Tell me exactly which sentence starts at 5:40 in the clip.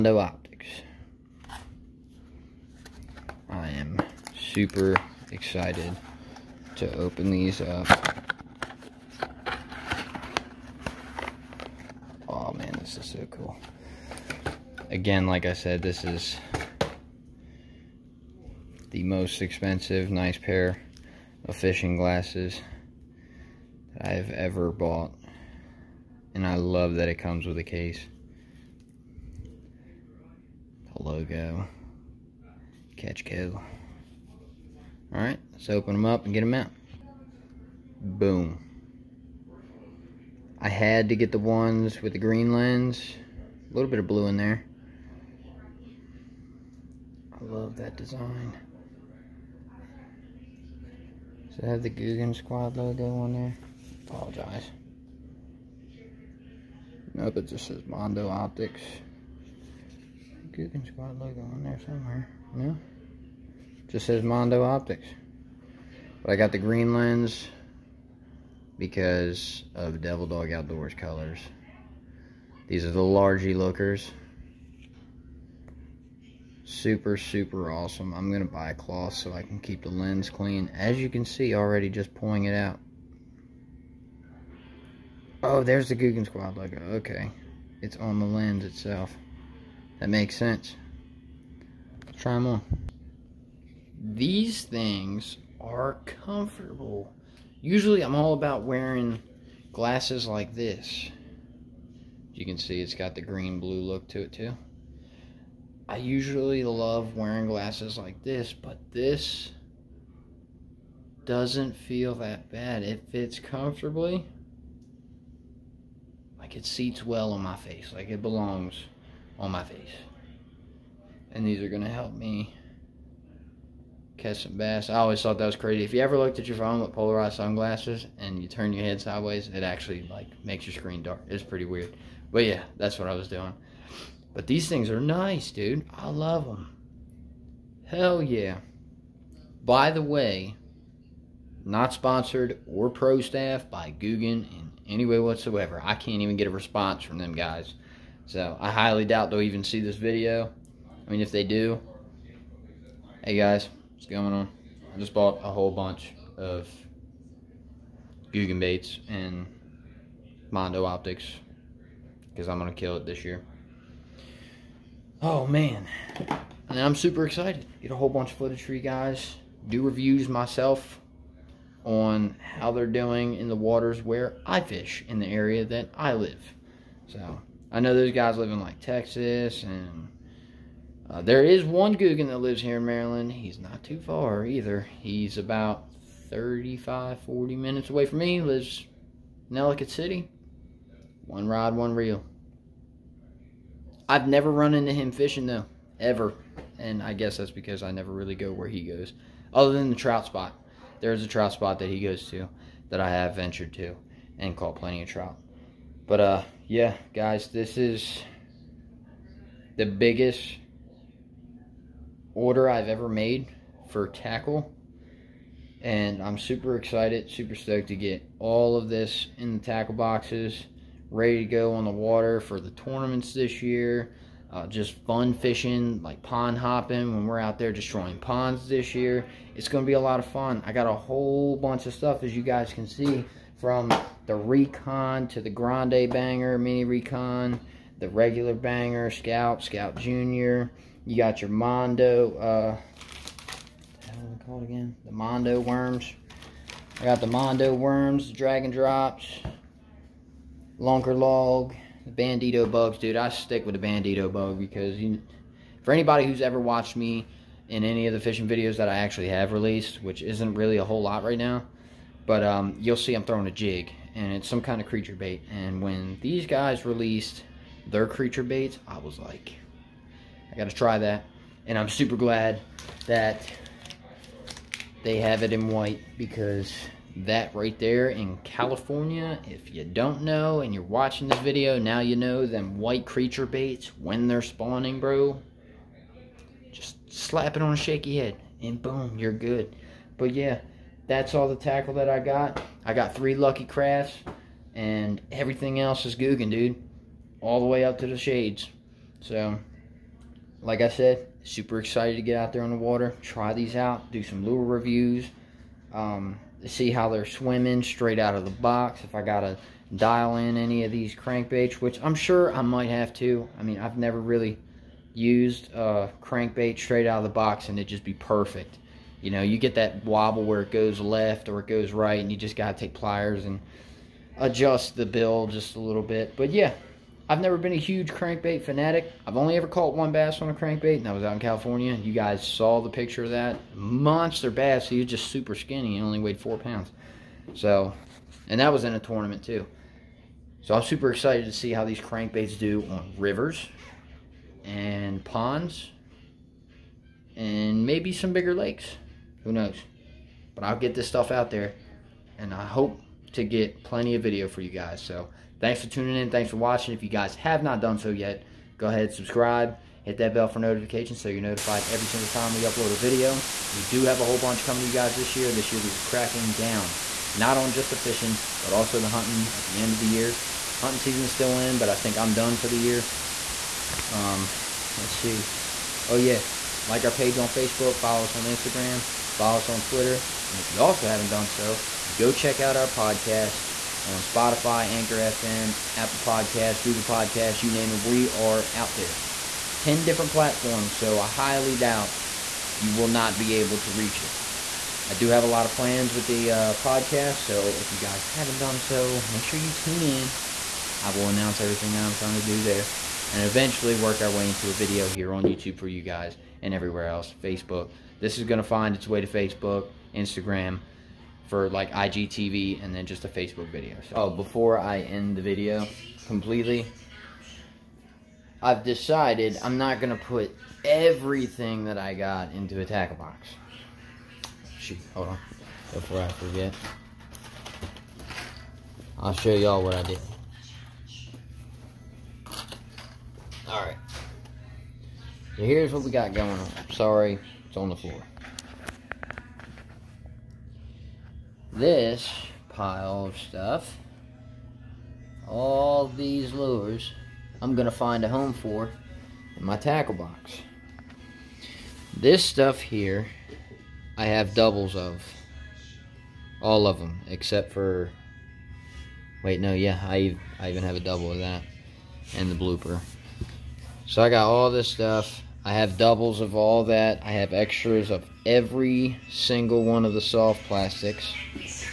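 So I'm super excited to see how these crankbaits do on rivers and ponds and maybe some bigger lakes.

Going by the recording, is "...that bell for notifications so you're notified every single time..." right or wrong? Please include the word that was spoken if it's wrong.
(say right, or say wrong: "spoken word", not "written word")
right.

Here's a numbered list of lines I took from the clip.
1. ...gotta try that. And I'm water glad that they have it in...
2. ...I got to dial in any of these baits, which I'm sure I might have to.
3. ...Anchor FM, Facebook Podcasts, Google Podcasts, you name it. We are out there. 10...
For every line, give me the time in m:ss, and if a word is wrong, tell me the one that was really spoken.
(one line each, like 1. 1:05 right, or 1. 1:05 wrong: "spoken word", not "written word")
1. 4:30 wrong: "super", not "water"
2. 5:09 wrong: "crankbaits", not "baits"
3. 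6:24 wrong: "Apple", not "Facebook".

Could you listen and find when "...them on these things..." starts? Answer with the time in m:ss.
1:32.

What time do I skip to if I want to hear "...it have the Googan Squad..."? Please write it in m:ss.
0:51.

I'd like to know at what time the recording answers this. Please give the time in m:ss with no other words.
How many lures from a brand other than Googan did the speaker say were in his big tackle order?
4:53.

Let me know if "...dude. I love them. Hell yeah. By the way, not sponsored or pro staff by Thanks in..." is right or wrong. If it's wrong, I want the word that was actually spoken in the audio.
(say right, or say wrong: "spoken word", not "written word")
wrong: "Googan", not "Thanks".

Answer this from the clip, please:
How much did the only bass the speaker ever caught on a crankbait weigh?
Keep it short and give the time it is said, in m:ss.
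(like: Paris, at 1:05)
4 pounds, at 5:36.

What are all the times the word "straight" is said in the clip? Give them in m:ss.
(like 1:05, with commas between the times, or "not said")
5:07, 5:16.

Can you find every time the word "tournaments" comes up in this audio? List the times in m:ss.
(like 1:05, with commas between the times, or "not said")
3:42, 5:38.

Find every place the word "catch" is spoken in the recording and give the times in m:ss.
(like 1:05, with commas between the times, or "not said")
0:32, 2:04.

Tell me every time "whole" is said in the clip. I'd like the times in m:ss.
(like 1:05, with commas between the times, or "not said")
2:35, 2:47, 3:50, 4:20, 6:04.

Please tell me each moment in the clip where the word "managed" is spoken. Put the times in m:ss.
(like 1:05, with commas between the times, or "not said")
not said.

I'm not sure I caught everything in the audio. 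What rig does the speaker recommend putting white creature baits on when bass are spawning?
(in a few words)
Shaky head.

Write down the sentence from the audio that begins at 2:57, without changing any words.
So I know those guys live in like Texas and uh, there is one Googan that lives here in Maryland.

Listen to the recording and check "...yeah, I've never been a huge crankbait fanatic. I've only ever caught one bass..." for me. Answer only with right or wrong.
right.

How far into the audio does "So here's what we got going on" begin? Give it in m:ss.
7:15.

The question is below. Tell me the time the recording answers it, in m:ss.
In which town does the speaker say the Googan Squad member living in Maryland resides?
3:09.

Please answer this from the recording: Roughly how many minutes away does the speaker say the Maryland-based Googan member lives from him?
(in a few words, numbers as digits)
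35 to 40 minutes.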